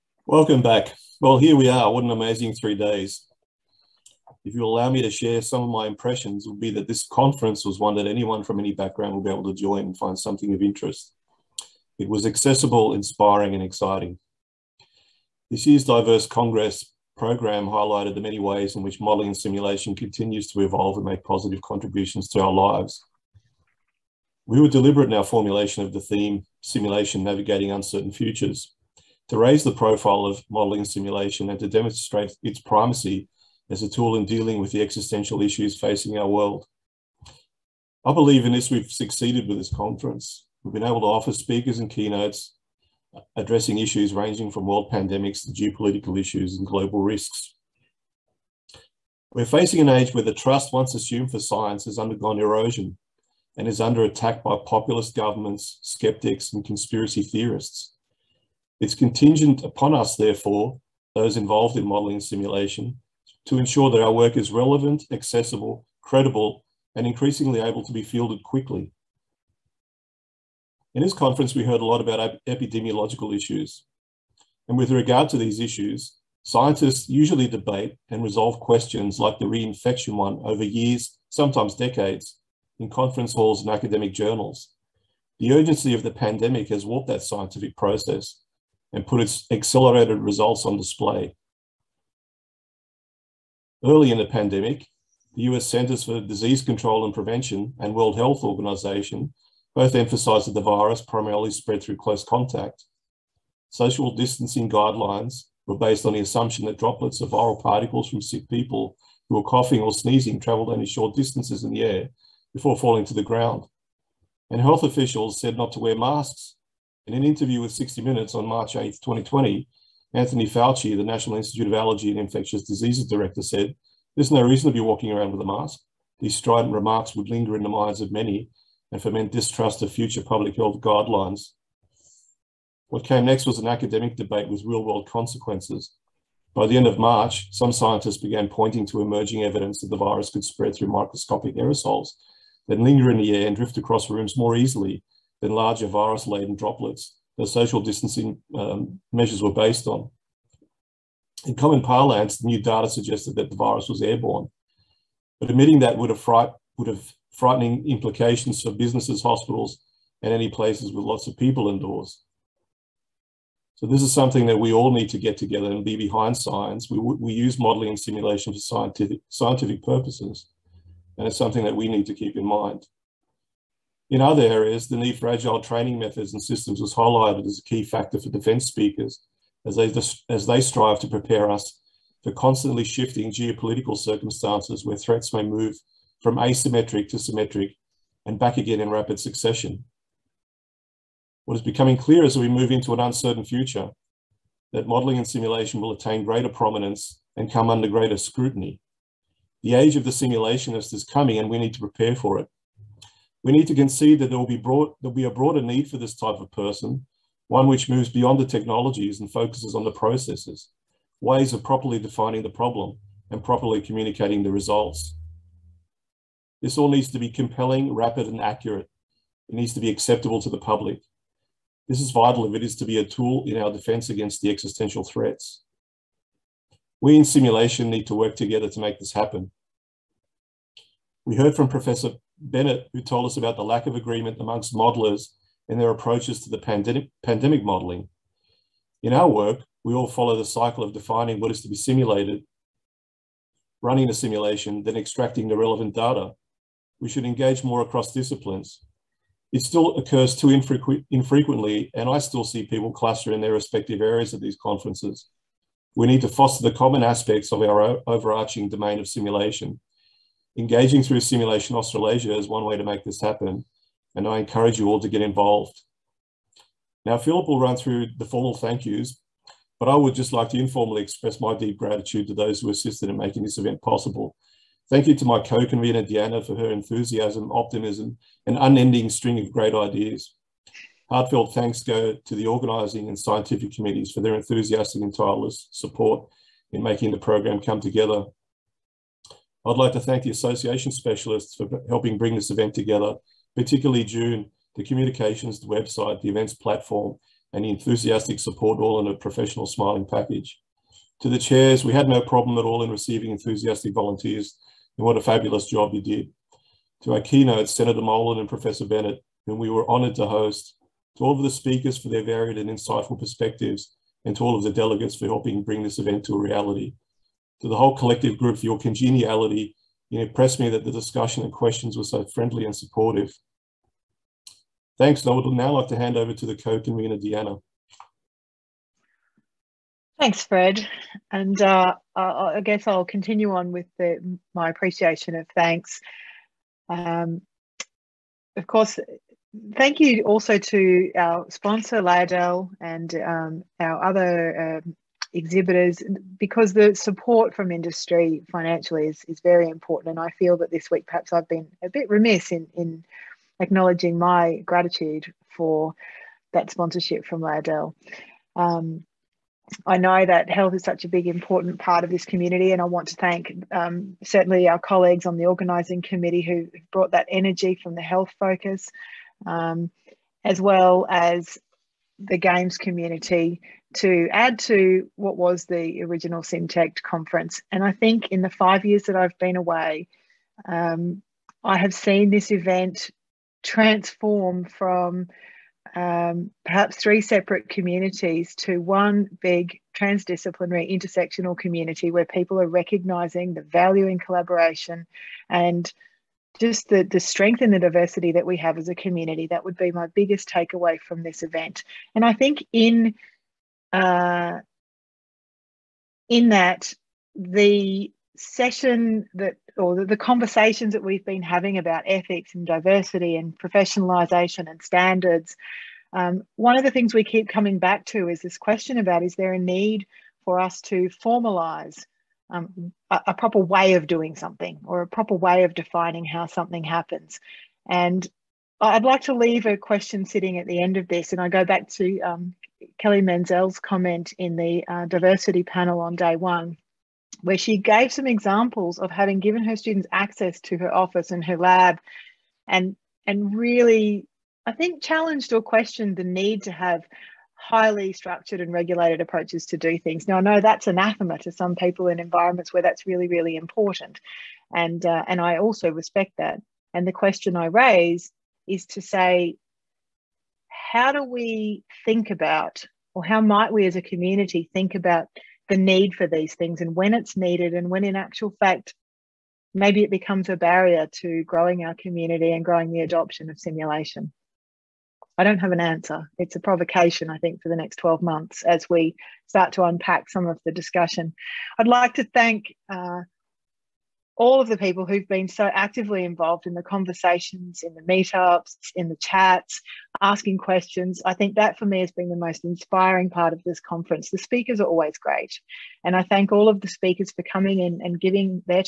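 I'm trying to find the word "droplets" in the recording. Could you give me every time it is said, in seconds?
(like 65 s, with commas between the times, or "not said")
106 s, 146 s.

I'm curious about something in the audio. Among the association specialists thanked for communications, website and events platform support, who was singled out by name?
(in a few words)
June.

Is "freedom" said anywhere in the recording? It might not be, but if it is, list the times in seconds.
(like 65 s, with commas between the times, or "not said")
not said.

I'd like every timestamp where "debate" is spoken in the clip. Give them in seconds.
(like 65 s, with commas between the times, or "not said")
77 s, 134 s.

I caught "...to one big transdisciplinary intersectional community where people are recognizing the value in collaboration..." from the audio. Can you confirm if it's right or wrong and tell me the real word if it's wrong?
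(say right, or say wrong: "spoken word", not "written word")
right.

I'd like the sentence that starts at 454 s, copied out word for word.
And, uh, and I also respect that.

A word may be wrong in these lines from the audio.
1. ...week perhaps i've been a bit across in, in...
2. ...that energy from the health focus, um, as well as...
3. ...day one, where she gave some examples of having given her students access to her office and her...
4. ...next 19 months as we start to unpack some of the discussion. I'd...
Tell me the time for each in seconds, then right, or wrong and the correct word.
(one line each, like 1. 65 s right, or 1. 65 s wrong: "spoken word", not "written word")
1. 350 s wrong: "remiss", not "across"
2. 367 s right
3. 436 s right
4. 477 s wrong: "12", not "19".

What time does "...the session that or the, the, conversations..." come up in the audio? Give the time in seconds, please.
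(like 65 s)
407 s.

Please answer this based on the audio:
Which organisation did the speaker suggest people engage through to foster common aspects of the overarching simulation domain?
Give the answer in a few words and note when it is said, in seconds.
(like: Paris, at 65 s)
Simulation Australasia, at 261 s.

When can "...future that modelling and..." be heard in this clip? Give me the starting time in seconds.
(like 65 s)
193 s.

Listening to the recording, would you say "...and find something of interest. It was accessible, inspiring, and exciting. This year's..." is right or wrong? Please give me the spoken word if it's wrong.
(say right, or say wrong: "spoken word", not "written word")
right.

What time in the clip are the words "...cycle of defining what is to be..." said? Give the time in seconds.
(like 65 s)
240 s.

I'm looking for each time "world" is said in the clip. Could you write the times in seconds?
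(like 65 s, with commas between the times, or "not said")
36 s, 44 s, 97 s, 134 s.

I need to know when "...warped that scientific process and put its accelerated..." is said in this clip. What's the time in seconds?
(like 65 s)
86 s.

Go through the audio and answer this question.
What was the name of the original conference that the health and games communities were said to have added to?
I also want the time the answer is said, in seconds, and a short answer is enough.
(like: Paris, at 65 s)
SimTecT, at 376 s.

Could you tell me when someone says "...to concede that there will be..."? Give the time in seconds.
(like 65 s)
203 s.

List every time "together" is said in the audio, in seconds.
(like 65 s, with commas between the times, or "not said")
165 s, 228 s, 287 s, 292 s.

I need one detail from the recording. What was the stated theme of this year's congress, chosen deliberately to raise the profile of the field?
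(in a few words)
Simulation Navigating Uncertain Futures.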